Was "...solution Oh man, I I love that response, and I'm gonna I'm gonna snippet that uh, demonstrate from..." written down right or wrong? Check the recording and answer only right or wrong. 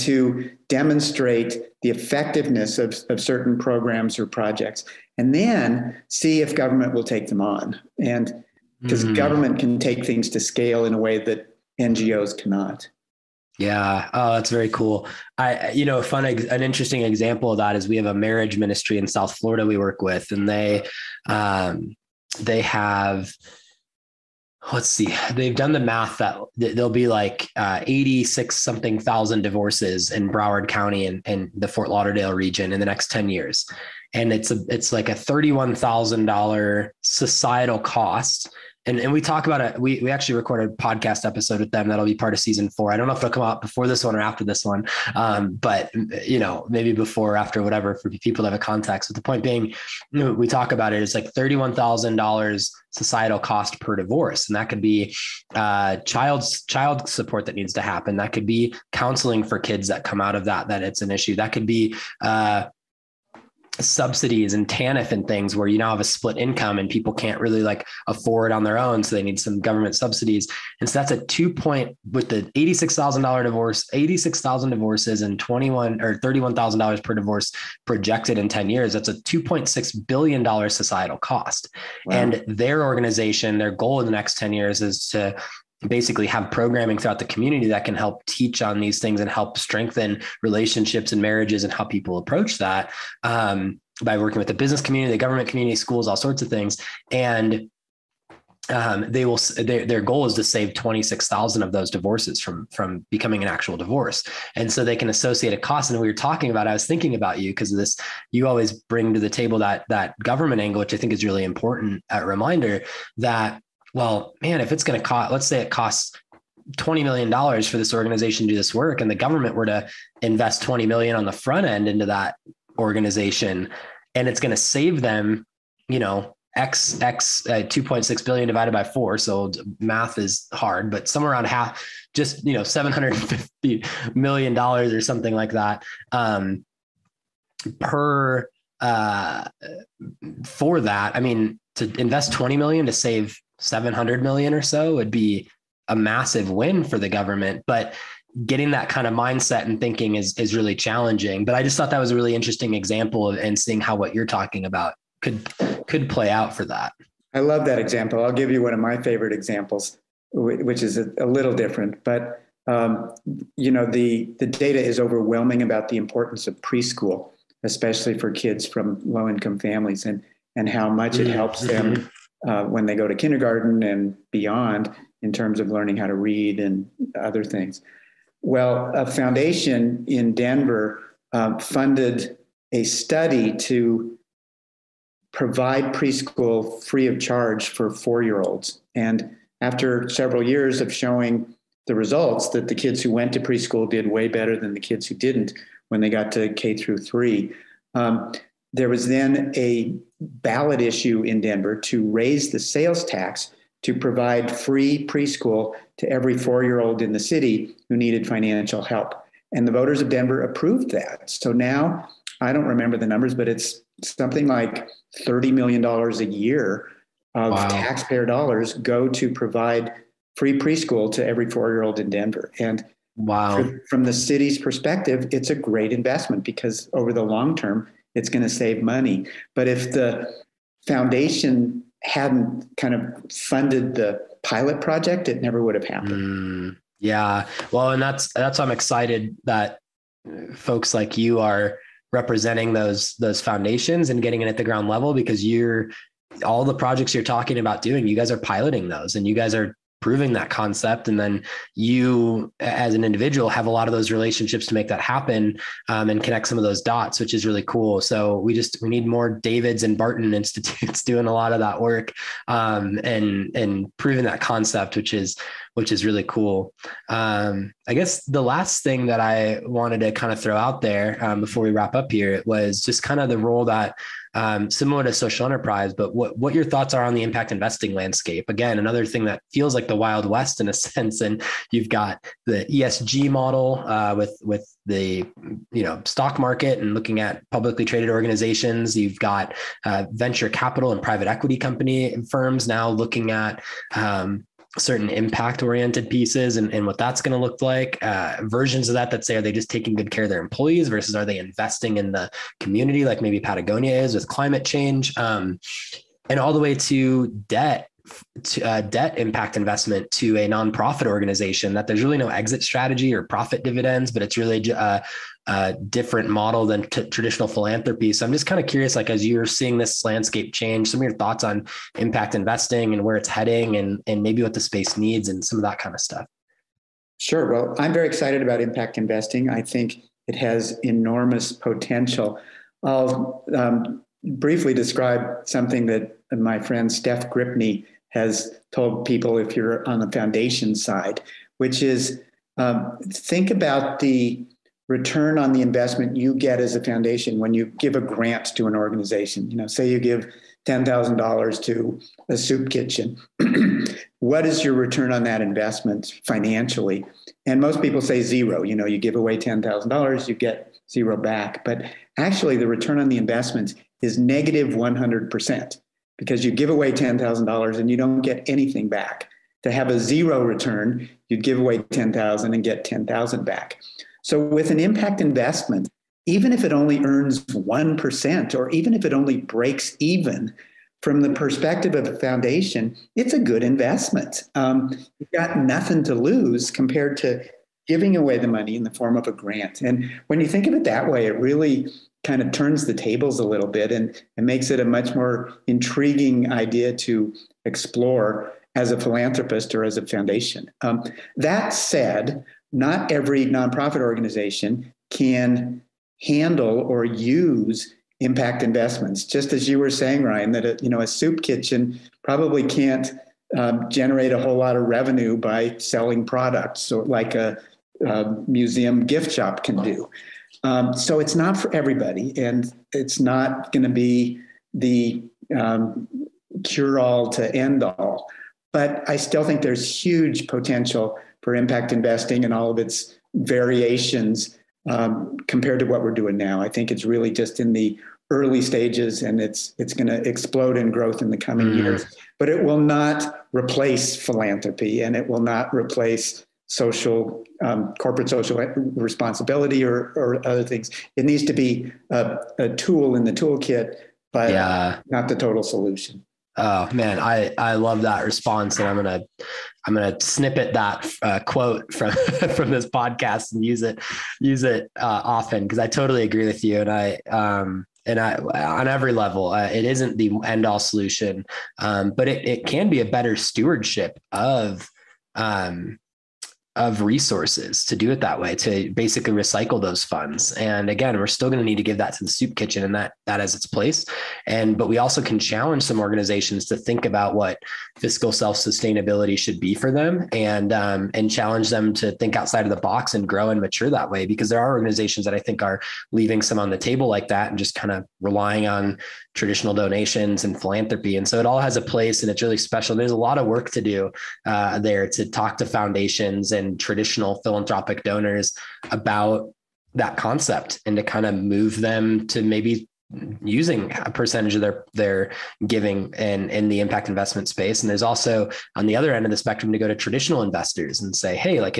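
wrong.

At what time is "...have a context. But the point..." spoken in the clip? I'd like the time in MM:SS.
00:48.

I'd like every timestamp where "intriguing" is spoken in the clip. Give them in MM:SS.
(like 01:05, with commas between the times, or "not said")
06:35.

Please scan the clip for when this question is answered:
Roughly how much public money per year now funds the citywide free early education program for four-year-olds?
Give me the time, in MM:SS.
03:35.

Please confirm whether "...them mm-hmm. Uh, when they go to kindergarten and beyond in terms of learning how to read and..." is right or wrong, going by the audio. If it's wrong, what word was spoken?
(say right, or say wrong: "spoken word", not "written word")
right.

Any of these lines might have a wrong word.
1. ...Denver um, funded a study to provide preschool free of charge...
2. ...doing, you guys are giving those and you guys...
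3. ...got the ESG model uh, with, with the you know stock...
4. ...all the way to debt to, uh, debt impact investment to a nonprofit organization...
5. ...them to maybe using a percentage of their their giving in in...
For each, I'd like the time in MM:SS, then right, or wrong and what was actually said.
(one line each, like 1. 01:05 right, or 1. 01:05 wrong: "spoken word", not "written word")
1. 03:00 right
2. 04:07 wrong: "piloting", not "giving"
3. 04:41 right
4. 05:06 right
5. 08:31 right.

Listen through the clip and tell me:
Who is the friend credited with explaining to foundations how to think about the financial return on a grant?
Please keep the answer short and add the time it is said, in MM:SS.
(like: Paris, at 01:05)
Steph Gripney, at 05:36.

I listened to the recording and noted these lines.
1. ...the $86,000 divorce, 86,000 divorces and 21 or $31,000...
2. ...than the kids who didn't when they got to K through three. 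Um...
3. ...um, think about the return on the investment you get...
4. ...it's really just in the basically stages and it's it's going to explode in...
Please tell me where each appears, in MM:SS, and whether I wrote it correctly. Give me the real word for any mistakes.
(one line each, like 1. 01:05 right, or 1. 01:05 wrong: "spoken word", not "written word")
1. 01:12 right
2. 03:14 right
3. 05:42 right
4. 07:16 wrong: "early", not "basically".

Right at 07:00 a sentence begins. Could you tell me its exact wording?
Um, so it's not for everybody, and it's not going to be the um, cure all to end all.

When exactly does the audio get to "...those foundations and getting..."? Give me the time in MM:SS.
04:03.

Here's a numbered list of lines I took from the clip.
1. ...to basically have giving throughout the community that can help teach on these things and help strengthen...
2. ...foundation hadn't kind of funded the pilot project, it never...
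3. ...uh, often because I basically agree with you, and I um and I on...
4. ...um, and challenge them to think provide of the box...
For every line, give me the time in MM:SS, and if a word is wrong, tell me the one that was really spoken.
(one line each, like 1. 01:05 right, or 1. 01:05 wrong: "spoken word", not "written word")
1. 01:25 wrong: "programming", not "giving"
2. 03:50 right
3. 07:44 wrong: "totally", not "basically"
4. 08:10 wrong: "outside", not "provide".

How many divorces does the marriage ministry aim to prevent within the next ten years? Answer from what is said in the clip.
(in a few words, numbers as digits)
26,000.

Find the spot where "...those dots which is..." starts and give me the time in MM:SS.
04:16.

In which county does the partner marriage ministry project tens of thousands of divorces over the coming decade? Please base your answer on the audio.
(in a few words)
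Broward County.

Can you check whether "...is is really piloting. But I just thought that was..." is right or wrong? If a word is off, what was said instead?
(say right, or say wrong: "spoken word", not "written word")
wrong: "challenging", not "piloting".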